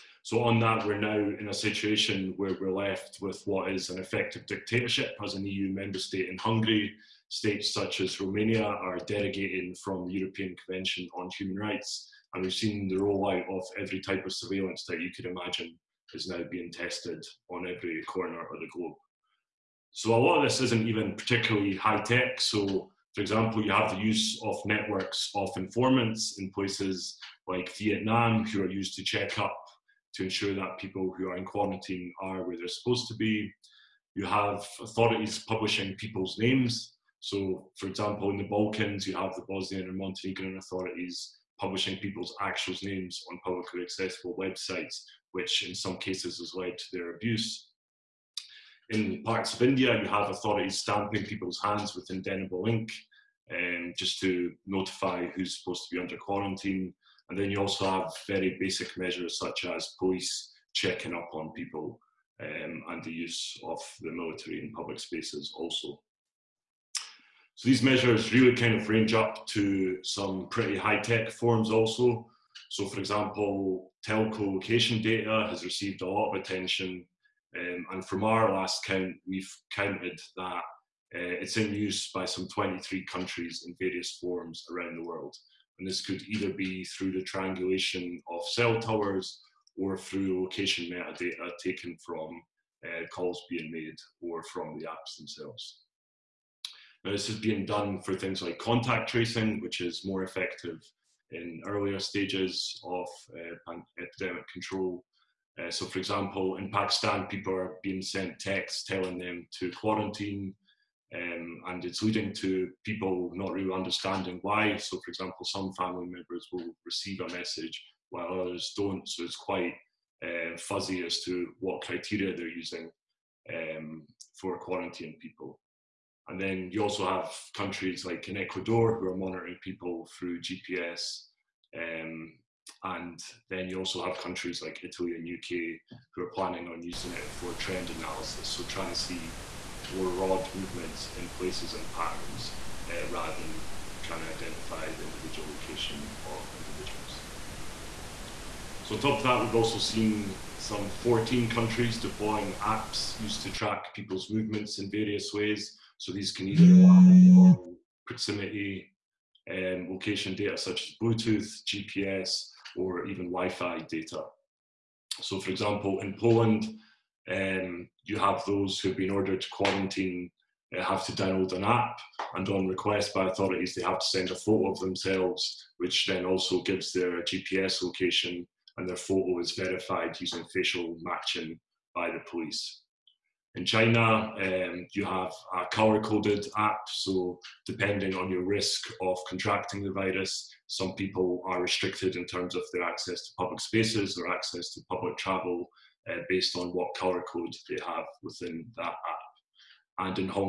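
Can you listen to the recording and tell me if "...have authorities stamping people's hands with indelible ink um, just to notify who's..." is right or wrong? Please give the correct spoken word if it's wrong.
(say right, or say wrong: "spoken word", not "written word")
right.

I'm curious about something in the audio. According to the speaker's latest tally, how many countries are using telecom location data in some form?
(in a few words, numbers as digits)
23.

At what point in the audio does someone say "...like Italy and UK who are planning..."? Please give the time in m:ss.
2:14.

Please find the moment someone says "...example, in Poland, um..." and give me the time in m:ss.
2:45.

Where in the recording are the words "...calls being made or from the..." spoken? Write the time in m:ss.
1:33.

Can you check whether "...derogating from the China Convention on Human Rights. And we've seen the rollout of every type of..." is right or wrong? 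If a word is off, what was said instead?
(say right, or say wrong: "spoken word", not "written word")
wrong: "European", not "China".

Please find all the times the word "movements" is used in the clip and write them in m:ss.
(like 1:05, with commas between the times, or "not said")
2:20, 2:34.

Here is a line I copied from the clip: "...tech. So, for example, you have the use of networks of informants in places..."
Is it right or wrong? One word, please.
right.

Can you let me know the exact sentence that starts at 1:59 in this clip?
So, it's quite uh, fuzzy as to what criteria they're using um, for quarantining people.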